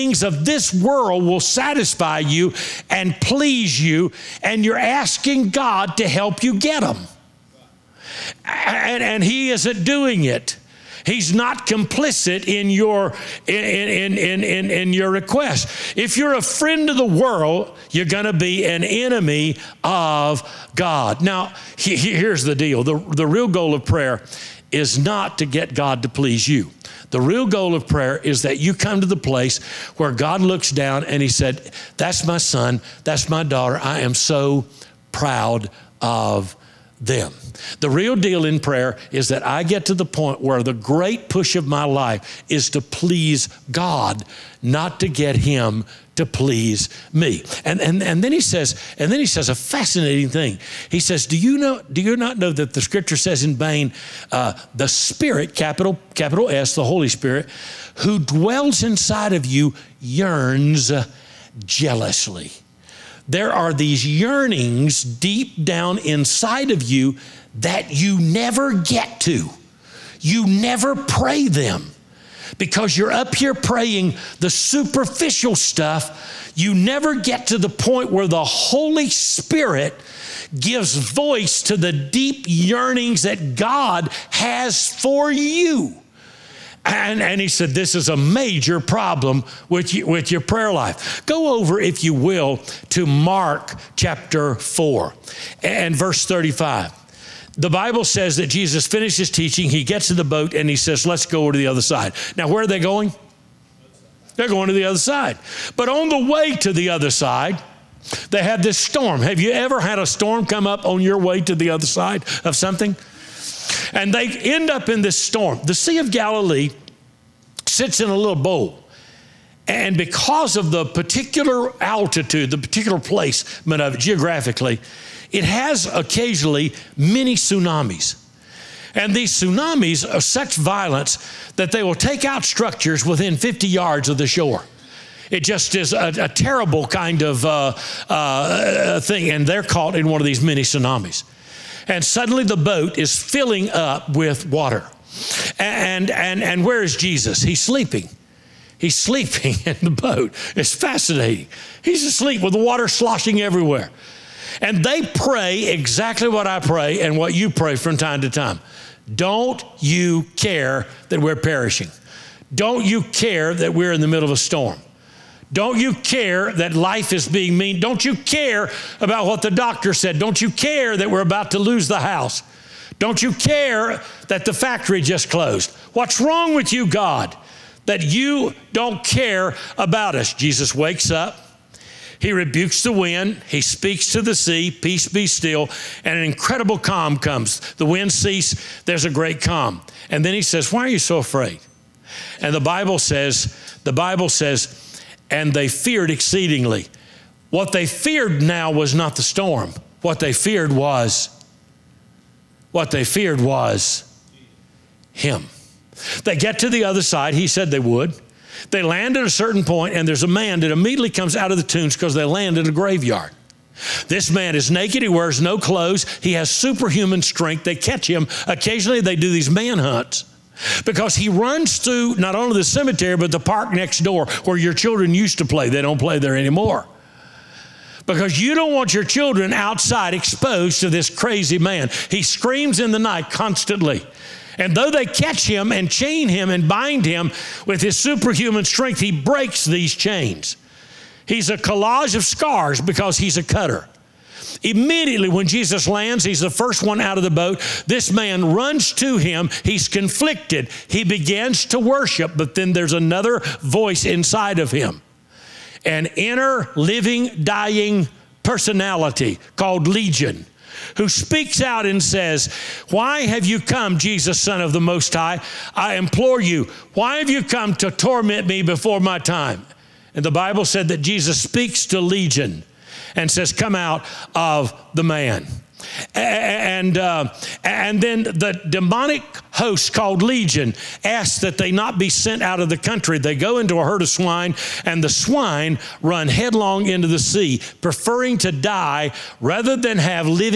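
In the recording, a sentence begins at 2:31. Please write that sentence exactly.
He's asleep with the water sloshing everywhere.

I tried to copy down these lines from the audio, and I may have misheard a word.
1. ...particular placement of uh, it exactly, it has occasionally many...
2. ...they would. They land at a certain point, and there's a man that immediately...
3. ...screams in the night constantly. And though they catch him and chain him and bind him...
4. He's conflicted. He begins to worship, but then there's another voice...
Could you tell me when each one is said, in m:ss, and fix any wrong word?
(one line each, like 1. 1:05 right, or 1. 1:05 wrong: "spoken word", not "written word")
1. 2:02 wrong: "geographically", not "exactly"
2. 3:27 right
3. 3:52 right
4. 4:09 right.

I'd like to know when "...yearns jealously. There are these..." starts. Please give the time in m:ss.
0:59.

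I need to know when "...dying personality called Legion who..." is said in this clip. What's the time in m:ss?
4:17.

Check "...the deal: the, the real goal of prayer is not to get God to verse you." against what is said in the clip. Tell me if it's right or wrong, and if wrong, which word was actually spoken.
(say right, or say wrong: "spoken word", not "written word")
wrong: "please", not "verse".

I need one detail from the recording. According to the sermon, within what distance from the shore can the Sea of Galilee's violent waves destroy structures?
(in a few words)
50 yards.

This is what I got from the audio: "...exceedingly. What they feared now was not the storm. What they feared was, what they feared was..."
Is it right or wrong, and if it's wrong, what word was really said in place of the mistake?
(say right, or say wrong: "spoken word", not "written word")
right.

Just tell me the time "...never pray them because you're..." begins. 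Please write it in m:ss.
1:10.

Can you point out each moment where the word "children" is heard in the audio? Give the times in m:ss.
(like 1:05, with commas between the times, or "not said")
3:44, 3:49.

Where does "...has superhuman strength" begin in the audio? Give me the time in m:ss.
3:36.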